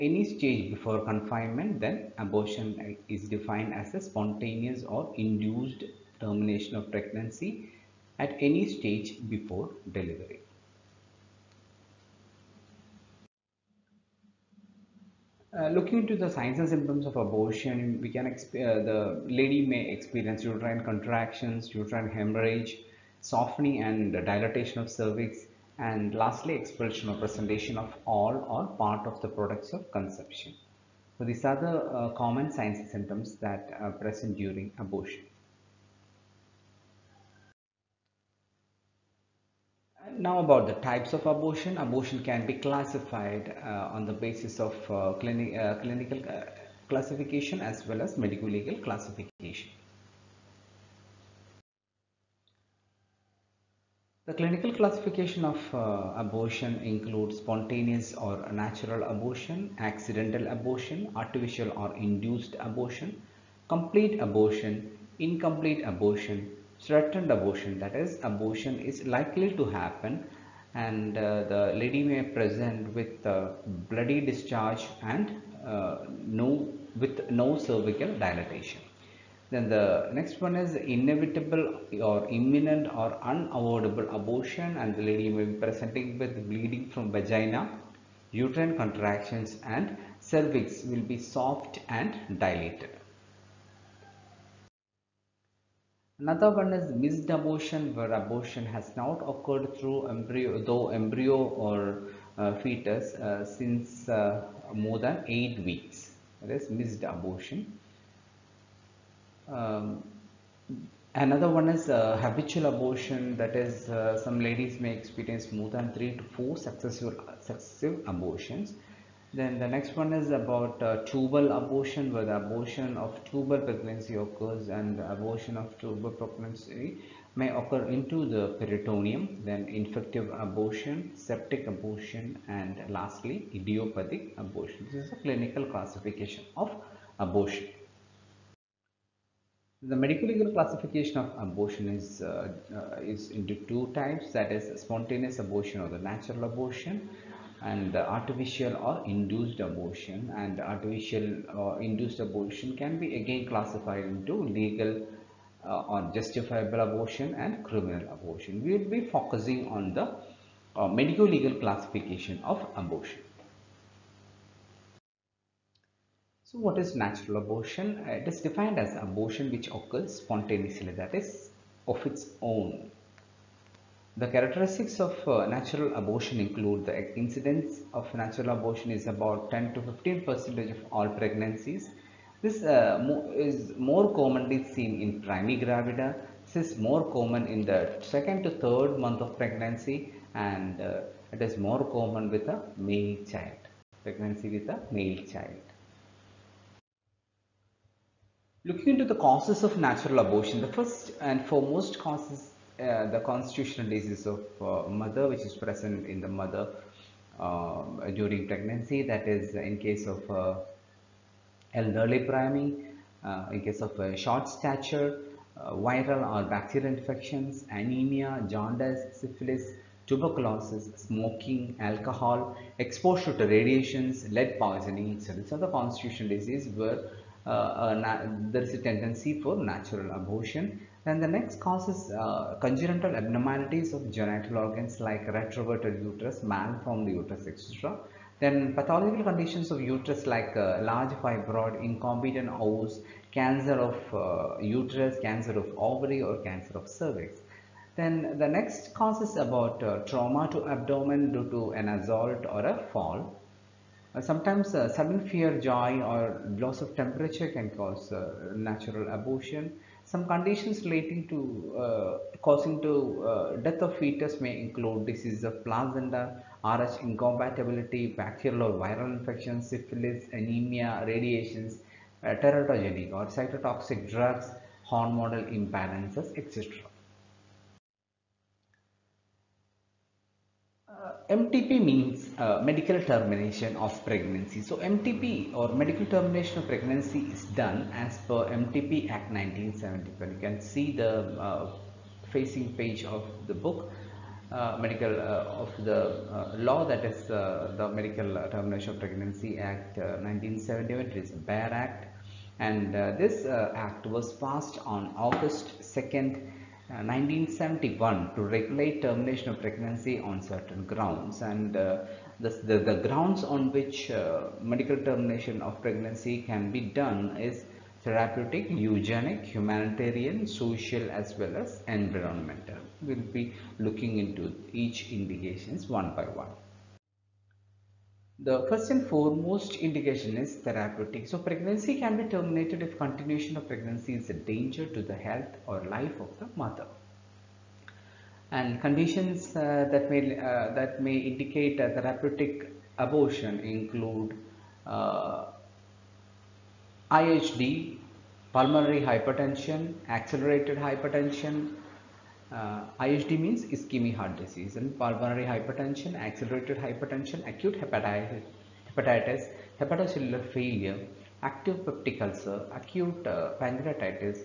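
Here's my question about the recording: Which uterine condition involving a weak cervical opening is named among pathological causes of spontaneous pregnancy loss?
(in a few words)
Incompetent os.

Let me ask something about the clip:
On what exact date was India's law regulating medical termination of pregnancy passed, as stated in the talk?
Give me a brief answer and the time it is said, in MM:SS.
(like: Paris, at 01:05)
August 2, 1971, at 05:05.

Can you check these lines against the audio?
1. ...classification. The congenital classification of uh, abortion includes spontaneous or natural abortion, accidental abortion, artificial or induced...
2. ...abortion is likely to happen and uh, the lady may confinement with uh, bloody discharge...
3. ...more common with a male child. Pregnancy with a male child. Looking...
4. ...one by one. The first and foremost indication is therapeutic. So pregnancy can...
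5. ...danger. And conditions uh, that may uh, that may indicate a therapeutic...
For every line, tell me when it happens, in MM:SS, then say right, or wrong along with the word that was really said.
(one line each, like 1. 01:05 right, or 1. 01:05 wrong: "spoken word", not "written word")
1. 00:48 wrong: "clinical", not "congenital"
2. 01:08 wrong: "present", not "confinement"
3. 03:11 right
4. 05:25 right
5. 05:36 wrong: "mother", not "danger".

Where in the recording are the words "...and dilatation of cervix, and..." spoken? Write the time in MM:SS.
00:23.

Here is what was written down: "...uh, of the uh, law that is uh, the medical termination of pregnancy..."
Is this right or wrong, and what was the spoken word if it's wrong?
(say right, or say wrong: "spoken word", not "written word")
right.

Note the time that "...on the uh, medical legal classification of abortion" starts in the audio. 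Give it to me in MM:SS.
02:39.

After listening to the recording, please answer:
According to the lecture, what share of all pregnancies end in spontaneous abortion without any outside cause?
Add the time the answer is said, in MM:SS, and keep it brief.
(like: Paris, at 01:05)
10 to 15 percent, at 02:59.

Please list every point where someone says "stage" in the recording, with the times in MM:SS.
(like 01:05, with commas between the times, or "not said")
00:00, 00:08.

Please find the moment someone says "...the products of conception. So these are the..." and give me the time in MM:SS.
00:29.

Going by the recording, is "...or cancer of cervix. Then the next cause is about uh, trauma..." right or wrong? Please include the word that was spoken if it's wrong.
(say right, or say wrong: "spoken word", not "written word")
right.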